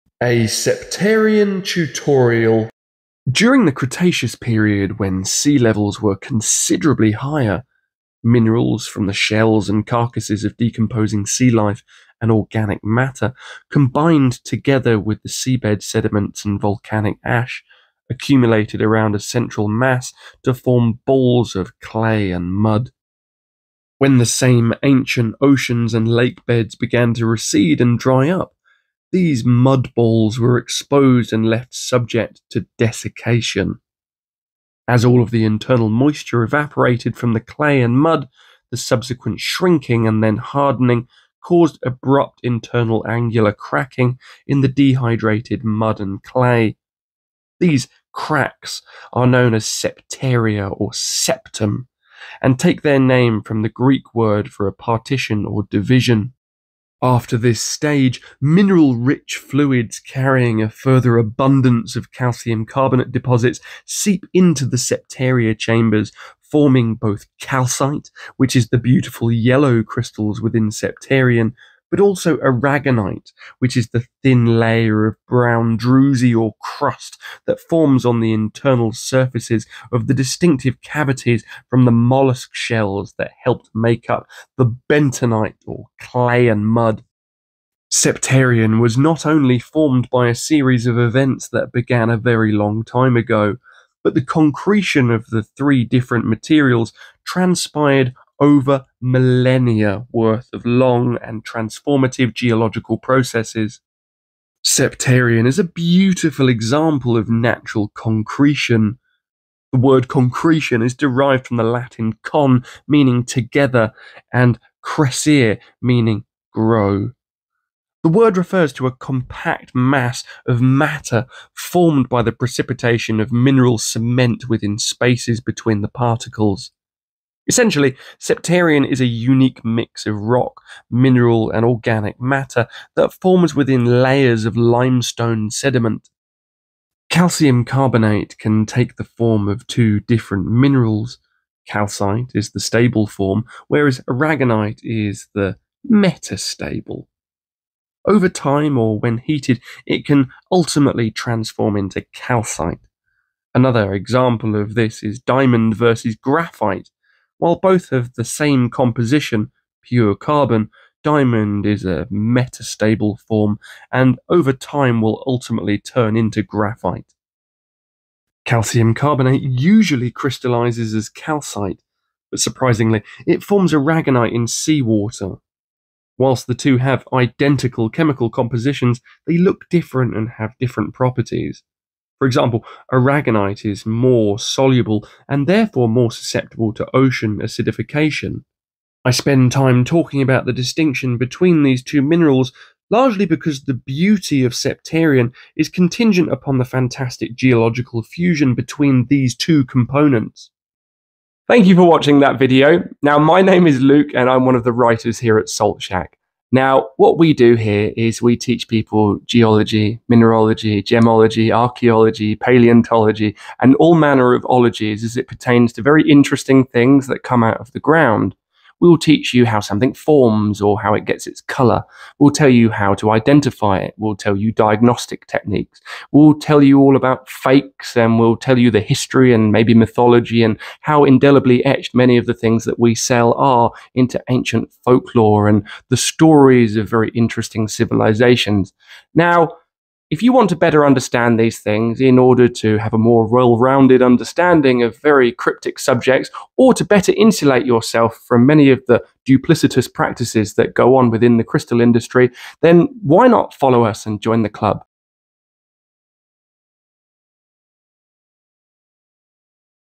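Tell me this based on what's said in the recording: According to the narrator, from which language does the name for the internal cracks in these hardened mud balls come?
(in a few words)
Greek.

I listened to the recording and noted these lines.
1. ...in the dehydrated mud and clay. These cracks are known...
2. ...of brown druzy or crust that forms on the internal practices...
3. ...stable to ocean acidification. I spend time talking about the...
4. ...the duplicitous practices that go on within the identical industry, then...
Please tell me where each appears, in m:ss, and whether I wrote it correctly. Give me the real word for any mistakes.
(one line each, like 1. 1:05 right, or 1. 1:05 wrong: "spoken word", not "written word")
1. 0:44 right
2. 1:15 wrong: "surfaces", not "practices"
3. 3:06 wrong: "susceptible", not "stable"
4. 4:08 wrong: "crystal", not "identical".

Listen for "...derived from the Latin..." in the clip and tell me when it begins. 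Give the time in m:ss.
1:50.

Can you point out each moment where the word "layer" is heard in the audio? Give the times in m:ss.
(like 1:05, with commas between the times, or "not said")
1:14, 2:14.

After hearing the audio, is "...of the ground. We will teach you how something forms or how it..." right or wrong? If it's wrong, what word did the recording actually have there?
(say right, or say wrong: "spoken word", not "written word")
right.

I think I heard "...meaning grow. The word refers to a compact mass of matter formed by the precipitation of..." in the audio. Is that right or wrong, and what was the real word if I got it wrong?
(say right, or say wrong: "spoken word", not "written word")
right.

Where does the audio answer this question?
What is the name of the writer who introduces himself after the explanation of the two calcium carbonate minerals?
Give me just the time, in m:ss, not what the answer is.
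3:23.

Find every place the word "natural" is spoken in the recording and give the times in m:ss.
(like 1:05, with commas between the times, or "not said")
1:47.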